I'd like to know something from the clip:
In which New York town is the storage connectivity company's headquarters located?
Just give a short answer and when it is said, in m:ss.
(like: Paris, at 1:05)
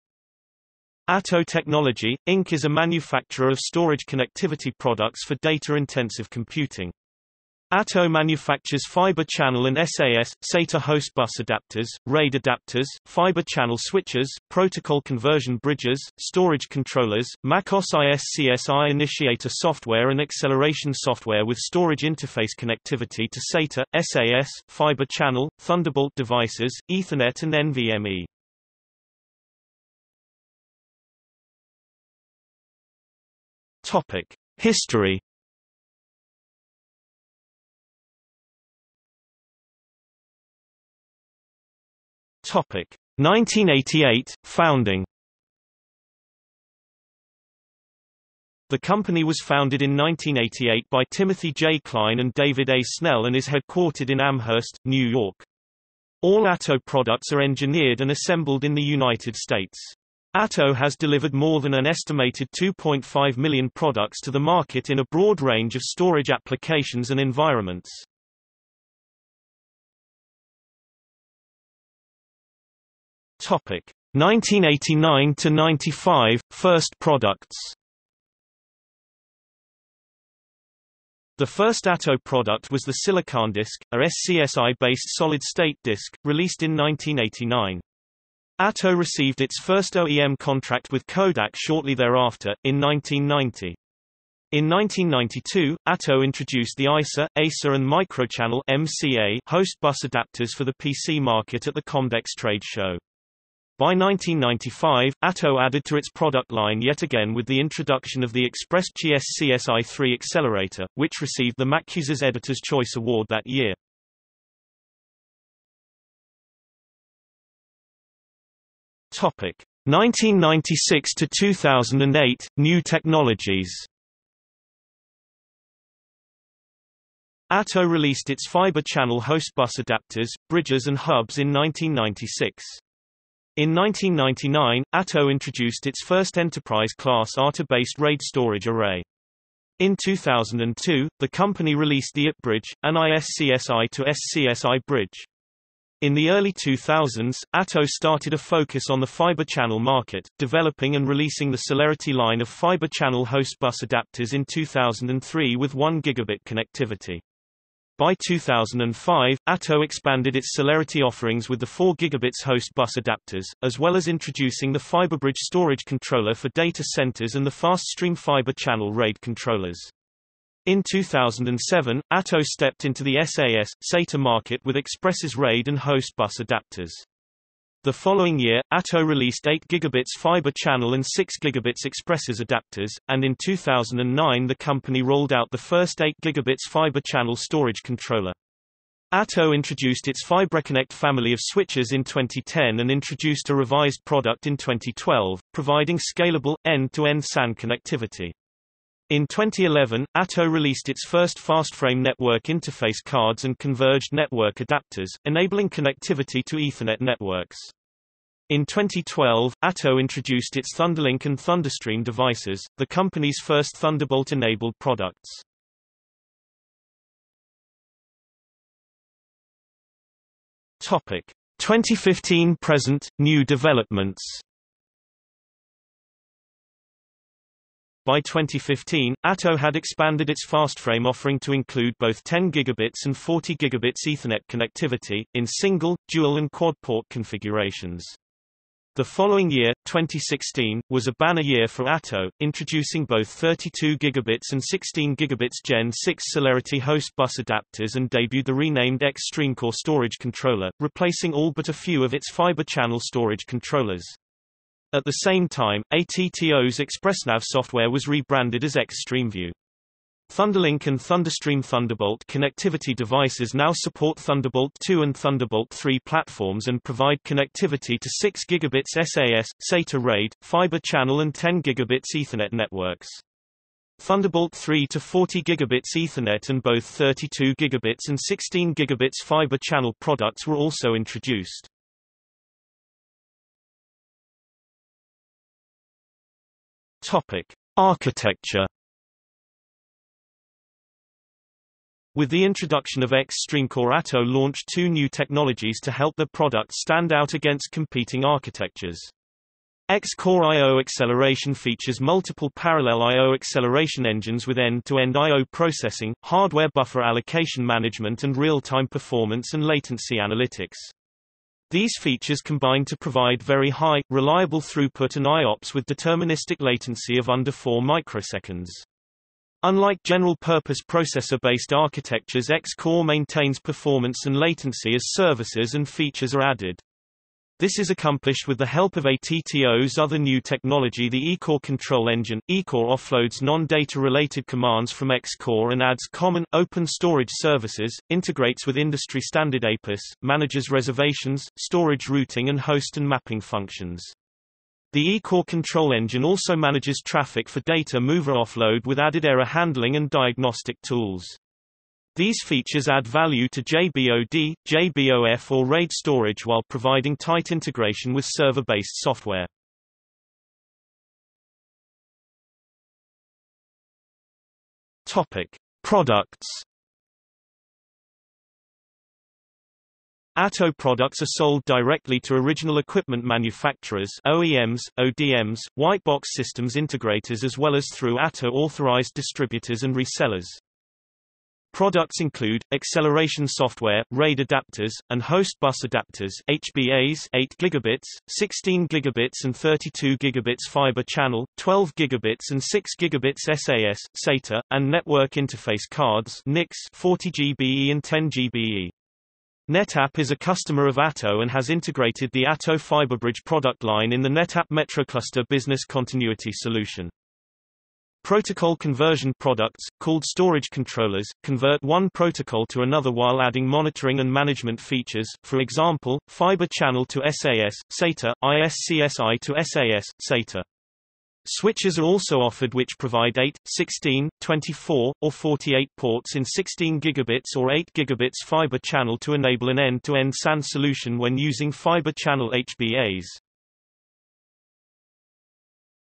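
Amherst, at 0:54.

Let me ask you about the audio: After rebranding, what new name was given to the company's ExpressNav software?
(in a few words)
XStreamView.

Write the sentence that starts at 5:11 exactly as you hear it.
These features combine to provide very high, reliable throughput and IOPS with deterministic latency of under 4 microseconds.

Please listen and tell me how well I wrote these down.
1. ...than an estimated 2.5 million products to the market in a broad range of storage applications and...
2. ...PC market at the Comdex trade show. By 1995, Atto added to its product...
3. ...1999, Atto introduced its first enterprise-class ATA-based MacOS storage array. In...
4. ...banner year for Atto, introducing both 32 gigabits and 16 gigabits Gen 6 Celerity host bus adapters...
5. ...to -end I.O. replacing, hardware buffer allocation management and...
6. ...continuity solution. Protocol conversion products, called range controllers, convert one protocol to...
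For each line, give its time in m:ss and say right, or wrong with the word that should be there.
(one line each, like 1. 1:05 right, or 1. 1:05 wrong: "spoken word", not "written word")
1. 1:01 right
2. 1:40 right
3. 2:13 wrong: "RAID", not "MacOS"
4. 4:01 right
5. 5:04 wrong: "processing", not "replacing"
6. 6:45 wrong: "storage", not "range".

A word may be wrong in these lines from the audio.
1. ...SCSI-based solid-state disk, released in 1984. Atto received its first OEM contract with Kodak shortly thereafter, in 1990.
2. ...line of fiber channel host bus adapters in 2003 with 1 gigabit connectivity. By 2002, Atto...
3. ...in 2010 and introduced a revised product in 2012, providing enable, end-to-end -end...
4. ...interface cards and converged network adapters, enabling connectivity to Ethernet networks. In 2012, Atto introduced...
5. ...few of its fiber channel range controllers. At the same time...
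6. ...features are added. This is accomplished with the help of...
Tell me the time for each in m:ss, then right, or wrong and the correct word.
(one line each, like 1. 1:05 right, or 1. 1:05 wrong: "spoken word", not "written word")
1. 1:23 wrong: "1989", not "1984"
2. 2:32 wrong: "2005", not "2002"
3. 3:11 wrong: "scalable", not "enable"
4. 3:22 right
5. 4:11 wrong: "storage", not "range"
6. 5:25 right.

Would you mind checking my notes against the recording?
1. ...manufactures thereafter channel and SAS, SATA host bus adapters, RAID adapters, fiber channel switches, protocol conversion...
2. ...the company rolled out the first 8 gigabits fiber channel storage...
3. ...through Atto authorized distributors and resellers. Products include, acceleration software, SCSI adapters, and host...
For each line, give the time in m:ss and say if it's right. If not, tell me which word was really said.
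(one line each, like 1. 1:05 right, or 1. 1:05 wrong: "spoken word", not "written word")
1. 0:08 wrong: "fiber", not "thereafter"
2. 3:04 right
3. 6:17 wrong: "RAID", not "SCSI".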